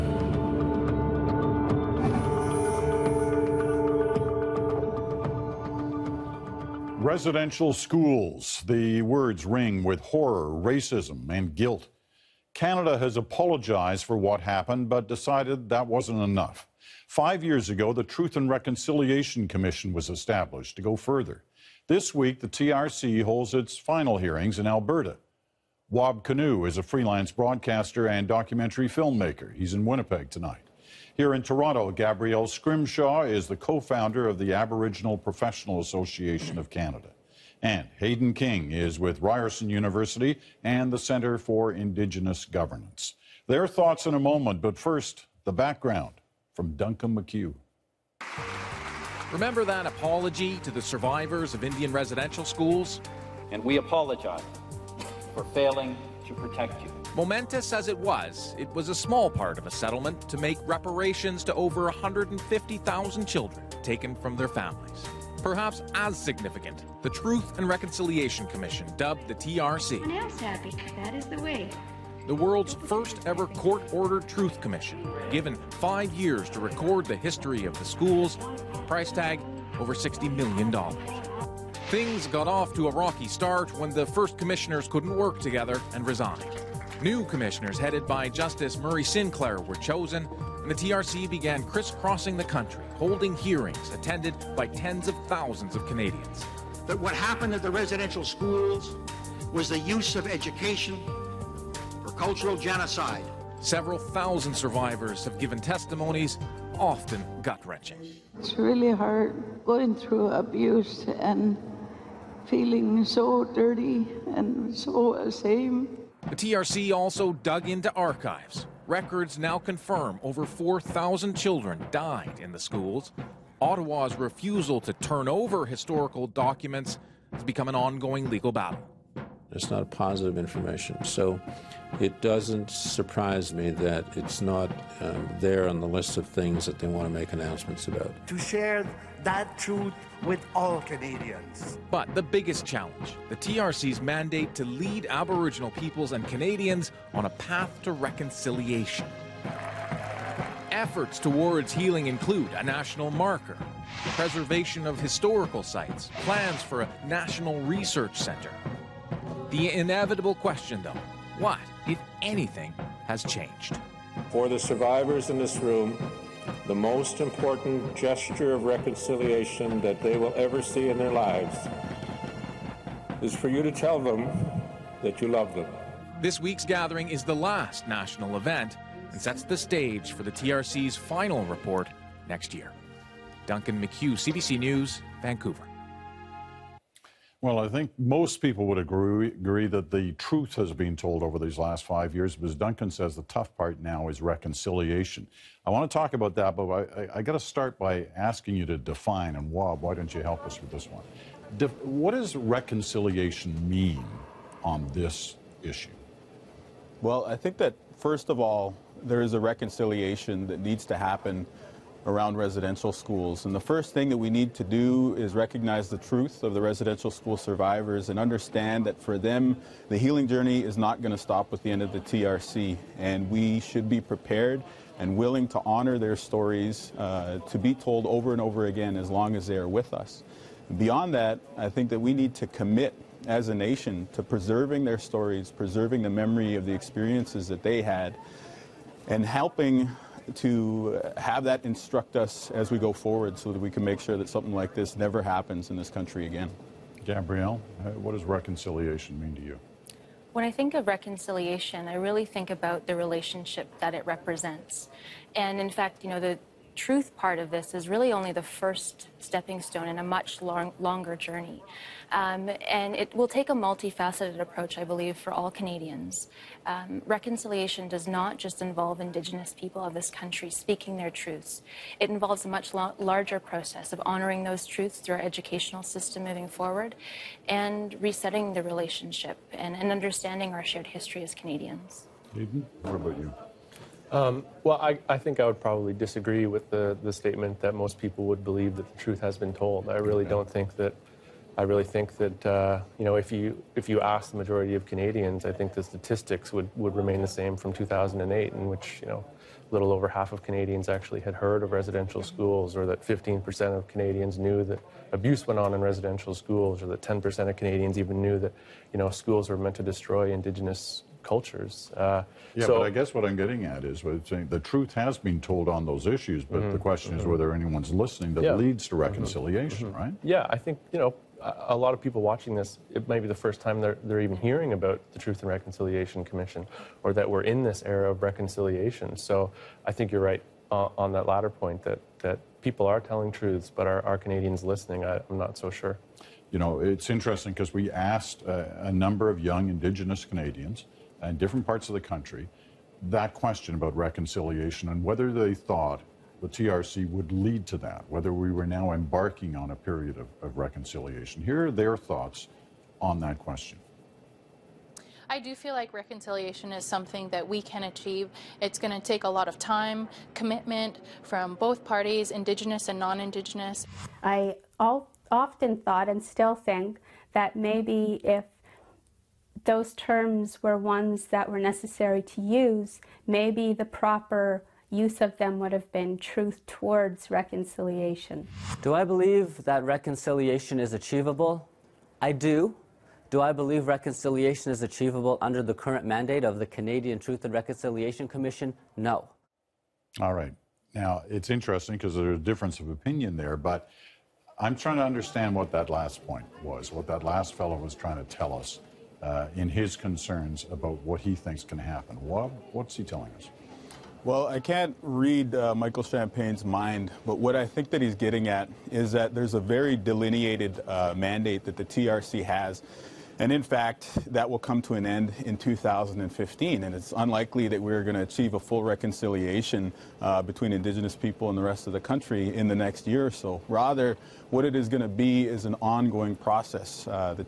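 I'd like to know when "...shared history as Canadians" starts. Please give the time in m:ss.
4:40.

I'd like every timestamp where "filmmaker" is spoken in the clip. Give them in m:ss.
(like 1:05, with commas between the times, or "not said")
0:28.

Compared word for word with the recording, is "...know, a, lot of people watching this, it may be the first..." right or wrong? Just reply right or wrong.
right.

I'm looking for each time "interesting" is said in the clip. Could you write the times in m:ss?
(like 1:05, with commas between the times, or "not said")
5:37, 6:31.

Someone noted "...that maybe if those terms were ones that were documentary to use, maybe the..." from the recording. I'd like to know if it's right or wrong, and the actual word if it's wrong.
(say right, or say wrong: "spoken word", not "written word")
wrong: "necessary", not "documentary".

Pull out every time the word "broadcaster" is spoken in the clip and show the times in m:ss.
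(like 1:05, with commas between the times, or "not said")
0:27.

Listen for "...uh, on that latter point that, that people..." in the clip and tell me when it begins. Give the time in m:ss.
5:30.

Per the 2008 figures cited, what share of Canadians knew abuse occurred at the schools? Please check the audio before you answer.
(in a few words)
15%.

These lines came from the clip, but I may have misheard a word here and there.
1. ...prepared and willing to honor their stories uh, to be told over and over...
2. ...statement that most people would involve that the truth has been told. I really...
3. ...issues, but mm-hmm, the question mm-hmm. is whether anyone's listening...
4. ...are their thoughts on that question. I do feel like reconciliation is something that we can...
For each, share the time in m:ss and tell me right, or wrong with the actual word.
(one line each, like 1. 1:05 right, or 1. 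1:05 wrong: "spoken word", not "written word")
1. 3:43 right
2. 4:47 wrong: "believe", not "involve"
3. 5:16 right
4. 5:51 right.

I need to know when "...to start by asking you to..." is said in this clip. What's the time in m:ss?
3:17.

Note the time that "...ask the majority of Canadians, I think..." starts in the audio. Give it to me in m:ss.
4:53.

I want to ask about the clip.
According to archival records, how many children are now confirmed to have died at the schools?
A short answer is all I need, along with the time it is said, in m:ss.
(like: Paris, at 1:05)
over 4,000, at 2:00.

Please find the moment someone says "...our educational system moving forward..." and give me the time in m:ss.
4:35.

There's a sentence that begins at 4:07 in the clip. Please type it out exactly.
Gabrielle, uh, what does reconciliation mean to you?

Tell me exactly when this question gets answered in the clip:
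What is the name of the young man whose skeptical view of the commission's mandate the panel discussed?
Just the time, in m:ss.
6:45.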